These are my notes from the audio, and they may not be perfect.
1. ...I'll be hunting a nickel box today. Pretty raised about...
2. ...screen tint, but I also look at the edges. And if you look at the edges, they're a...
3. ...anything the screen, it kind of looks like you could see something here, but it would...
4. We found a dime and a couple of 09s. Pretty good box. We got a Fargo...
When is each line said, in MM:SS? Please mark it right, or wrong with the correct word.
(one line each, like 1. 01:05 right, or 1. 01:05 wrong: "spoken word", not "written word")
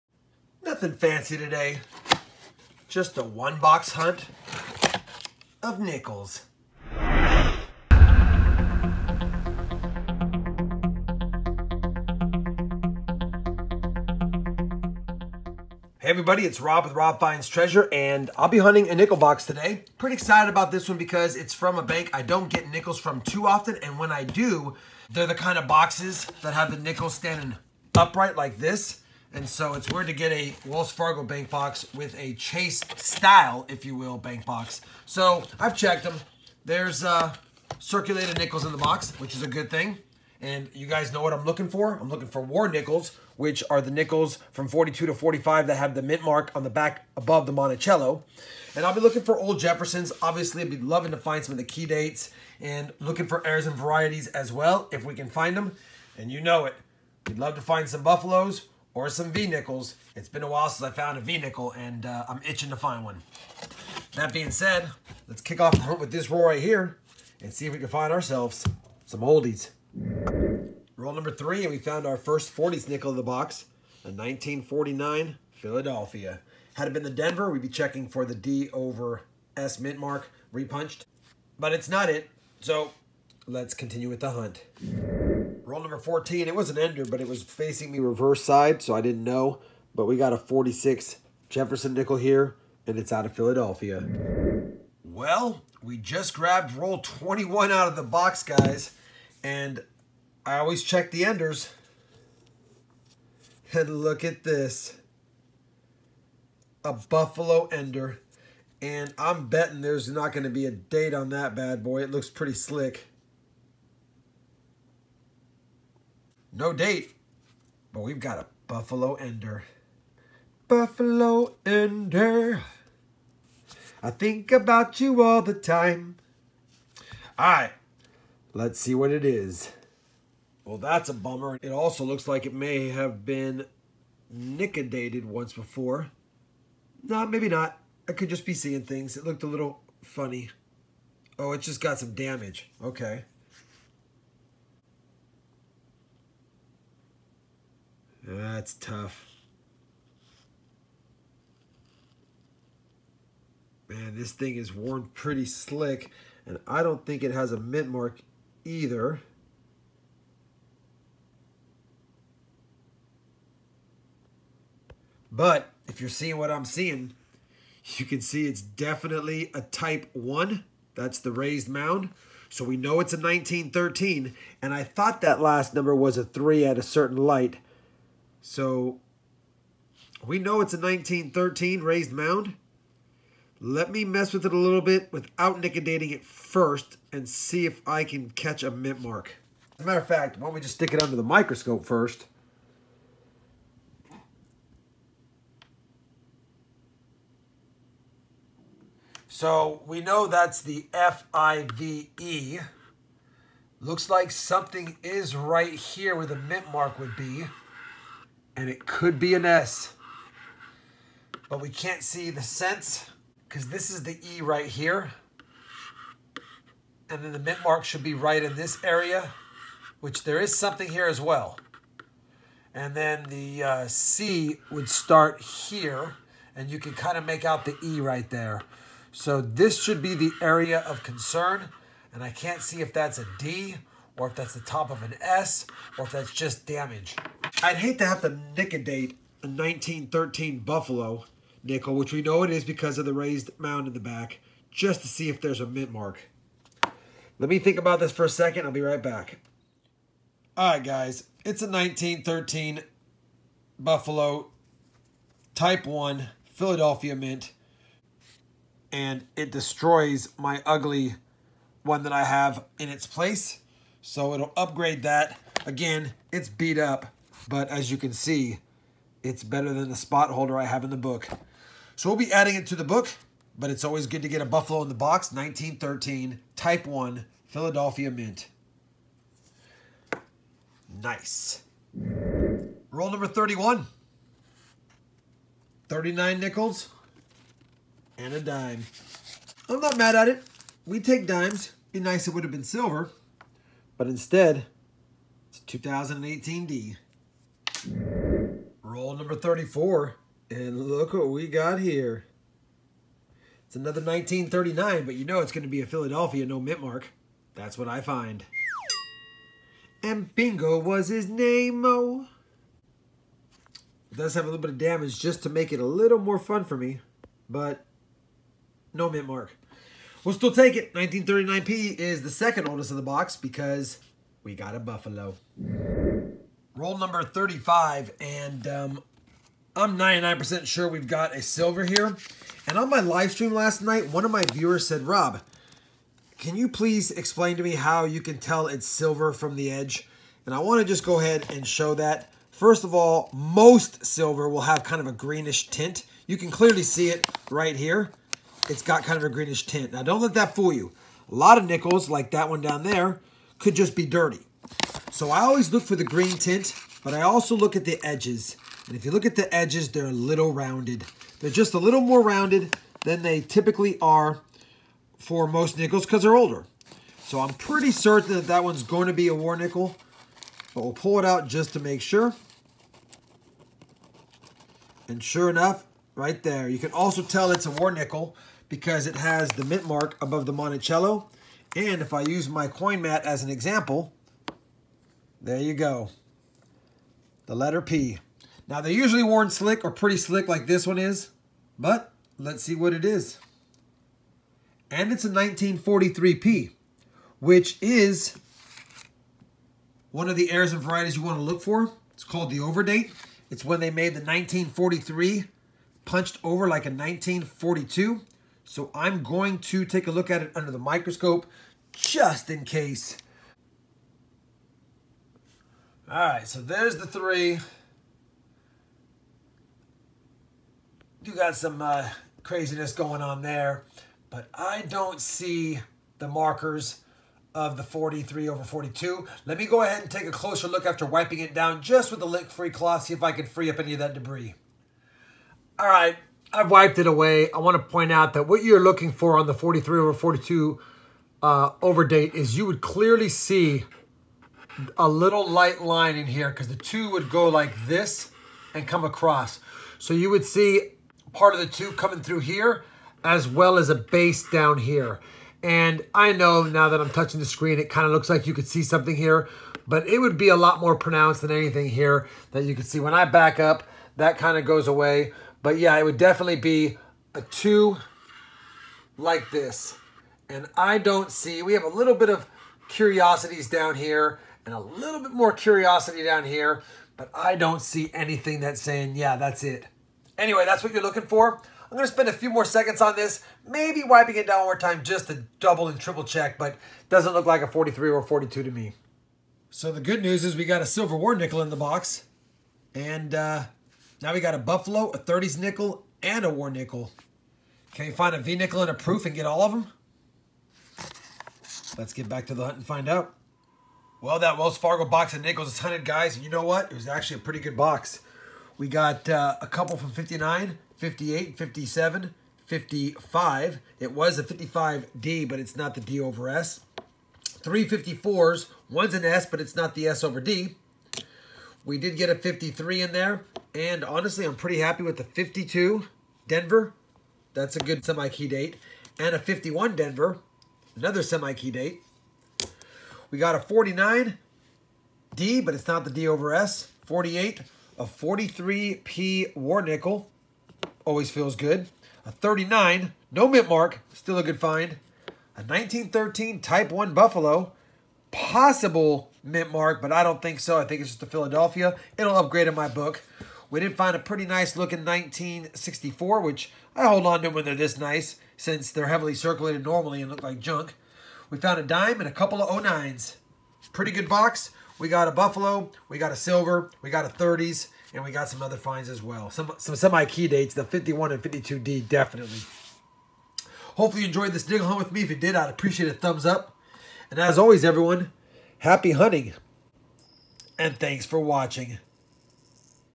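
1. 00:18 wrong: "excited", not "raised"
2. 05:56 wrong: "green", not "screen"
3. 07:37 wrong: "touching", not "anything"
4. 09:21 wrong: "Buffalo", not "Fargo".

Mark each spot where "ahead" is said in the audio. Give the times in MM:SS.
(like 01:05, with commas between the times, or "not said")
05:41, 07:09.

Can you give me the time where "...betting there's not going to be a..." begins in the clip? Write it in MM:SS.
01:49.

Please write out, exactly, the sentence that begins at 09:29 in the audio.
Some, some semi-key dates, the 51 and 52D definitely.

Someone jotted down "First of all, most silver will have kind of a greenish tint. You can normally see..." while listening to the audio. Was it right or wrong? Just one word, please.
wrong.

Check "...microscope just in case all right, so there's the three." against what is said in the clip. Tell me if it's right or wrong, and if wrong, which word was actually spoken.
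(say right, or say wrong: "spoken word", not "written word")
right.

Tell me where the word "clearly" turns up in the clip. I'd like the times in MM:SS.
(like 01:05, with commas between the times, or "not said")
05:46, 07:22.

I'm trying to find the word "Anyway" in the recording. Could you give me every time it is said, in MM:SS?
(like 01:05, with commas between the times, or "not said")
08:00.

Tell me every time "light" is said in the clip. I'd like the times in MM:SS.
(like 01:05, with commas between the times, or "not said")
02:57, 07:25.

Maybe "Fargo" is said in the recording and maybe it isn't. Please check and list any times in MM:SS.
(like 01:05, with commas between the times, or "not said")
00:30, 08:24.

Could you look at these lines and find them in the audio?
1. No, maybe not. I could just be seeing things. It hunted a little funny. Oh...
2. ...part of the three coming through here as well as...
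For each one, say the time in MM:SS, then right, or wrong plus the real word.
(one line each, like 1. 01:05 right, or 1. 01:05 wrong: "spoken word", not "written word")
1. 02:17 wrong: "looked", not "hunted"
2. 07:31 wrong: "two", not "three".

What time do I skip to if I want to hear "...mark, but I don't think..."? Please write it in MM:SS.
09:09.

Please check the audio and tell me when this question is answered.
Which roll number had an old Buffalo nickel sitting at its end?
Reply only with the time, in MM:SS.
01:36.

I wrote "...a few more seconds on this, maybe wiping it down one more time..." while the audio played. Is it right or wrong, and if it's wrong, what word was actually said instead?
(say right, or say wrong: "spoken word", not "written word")
right.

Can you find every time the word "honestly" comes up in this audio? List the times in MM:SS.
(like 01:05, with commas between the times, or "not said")
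08:44.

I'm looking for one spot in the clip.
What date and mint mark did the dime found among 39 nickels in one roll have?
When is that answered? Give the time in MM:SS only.
04:55.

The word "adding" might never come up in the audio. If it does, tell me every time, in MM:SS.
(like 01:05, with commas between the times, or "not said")
04:32.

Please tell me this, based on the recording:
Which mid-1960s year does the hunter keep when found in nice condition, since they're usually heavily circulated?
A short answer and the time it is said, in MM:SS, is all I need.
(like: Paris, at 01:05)
1964, at 09:15.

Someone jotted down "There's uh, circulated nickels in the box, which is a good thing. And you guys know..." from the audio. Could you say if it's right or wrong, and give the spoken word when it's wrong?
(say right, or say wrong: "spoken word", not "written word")
right.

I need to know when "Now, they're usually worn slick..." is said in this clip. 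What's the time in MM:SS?
06:28.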